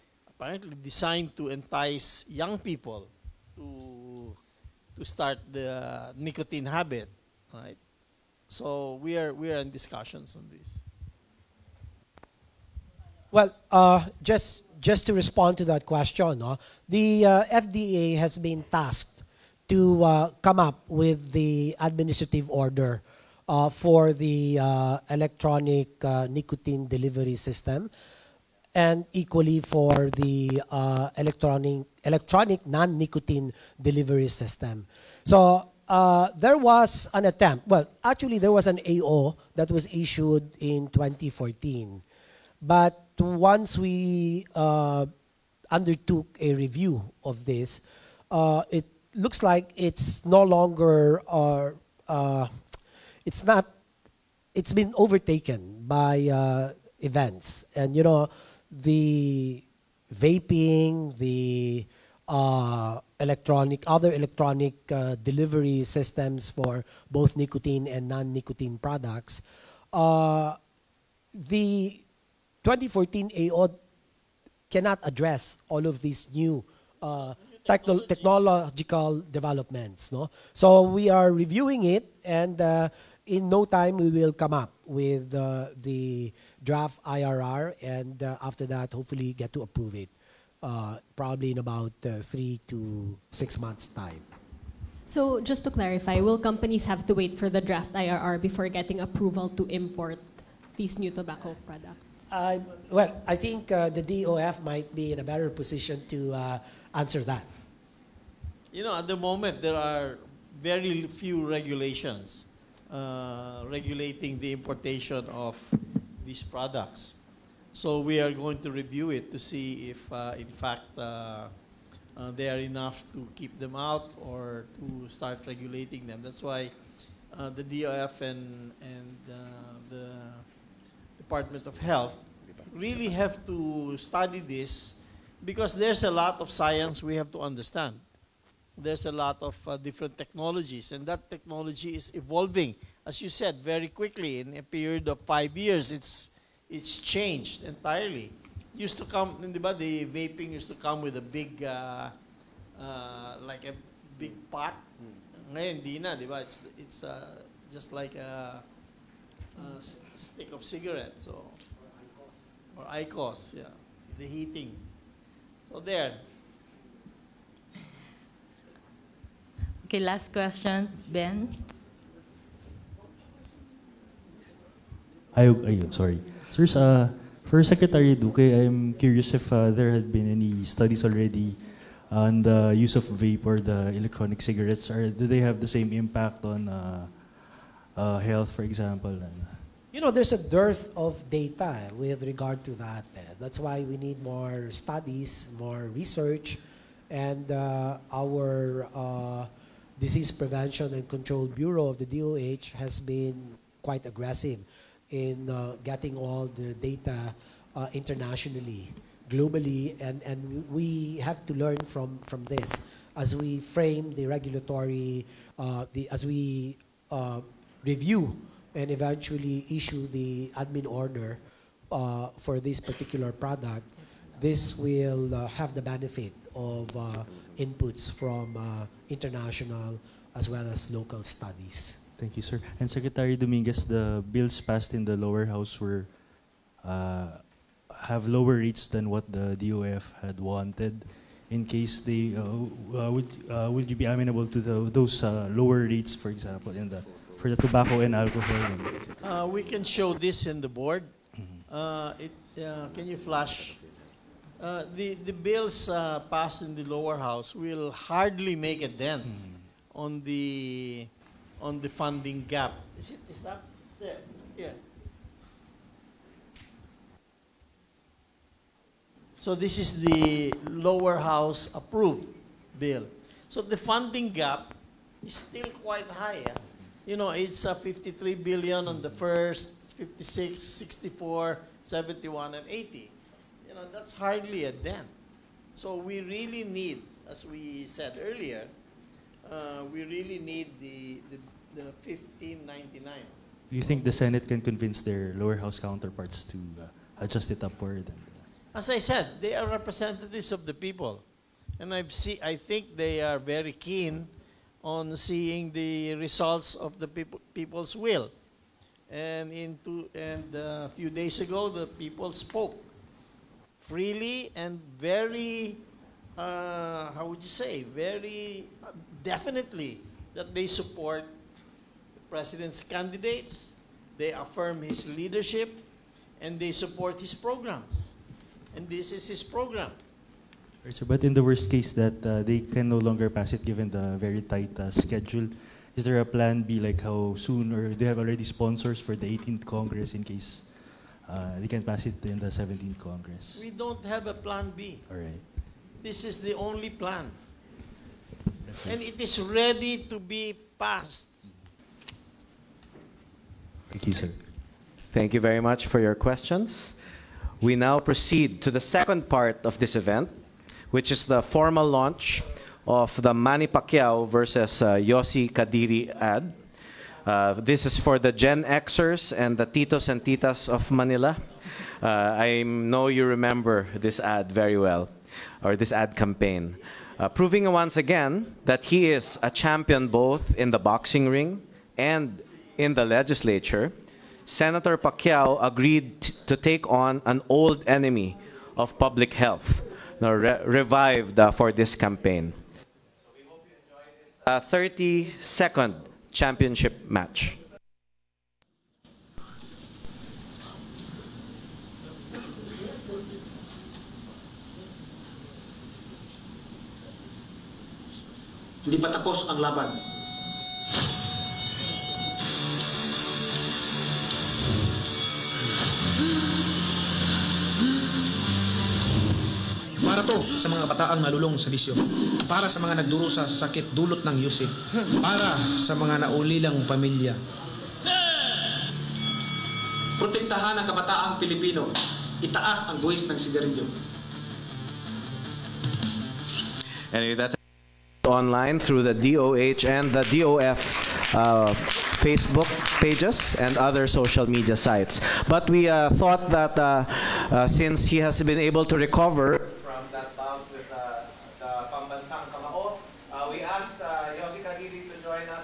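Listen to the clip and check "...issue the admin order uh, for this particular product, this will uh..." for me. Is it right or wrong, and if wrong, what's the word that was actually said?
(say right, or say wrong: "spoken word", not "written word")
right.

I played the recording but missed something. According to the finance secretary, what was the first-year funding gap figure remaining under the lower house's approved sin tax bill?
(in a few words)
53 billion.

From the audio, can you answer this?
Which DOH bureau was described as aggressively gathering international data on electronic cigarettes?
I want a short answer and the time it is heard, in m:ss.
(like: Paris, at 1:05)
Disease Prevention and Control Bureau, at 3:19.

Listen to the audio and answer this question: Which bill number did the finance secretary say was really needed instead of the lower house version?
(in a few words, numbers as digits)
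1599.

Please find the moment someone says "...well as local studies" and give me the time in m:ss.
3:50.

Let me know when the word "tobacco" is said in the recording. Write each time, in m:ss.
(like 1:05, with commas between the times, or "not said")
1:41, 4:07.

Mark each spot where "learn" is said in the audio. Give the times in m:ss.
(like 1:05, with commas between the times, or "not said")
3:31.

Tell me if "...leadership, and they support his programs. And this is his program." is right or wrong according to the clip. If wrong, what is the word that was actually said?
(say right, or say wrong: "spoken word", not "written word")
right.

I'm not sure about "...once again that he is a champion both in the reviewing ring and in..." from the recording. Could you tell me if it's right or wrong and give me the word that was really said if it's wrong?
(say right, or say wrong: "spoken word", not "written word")
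wrong: "boxing", not "reviewing".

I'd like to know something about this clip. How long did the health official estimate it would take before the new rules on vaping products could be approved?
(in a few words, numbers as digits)
3 to 6 months.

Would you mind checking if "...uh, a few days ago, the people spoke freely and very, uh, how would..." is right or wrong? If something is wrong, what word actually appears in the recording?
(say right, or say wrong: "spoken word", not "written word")
right.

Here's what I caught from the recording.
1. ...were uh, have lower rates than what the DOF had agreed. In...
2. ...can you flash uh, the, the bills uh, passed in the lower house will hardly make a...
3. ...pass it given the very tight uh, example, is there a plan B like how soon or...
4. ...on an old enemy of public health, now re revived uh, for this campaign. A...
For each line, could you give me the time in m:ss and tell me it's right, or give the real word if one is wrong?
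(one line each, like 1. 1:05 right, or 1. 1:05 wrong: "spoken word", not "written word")
1. 3:55 wrong: "wanted", not "agreed"
2. 4:12 right
3. 5:33 wrong: "schedule", not "example"
4. 6:26 right.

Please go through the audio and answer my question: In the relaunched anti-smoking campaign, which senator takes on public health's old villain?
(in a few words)
Manny Pacquiao.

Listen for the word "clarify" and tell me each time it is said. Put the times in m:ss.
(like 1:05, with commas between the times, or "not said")
1:35.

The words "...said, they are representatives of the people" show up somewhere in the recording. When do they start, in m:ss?
4:58.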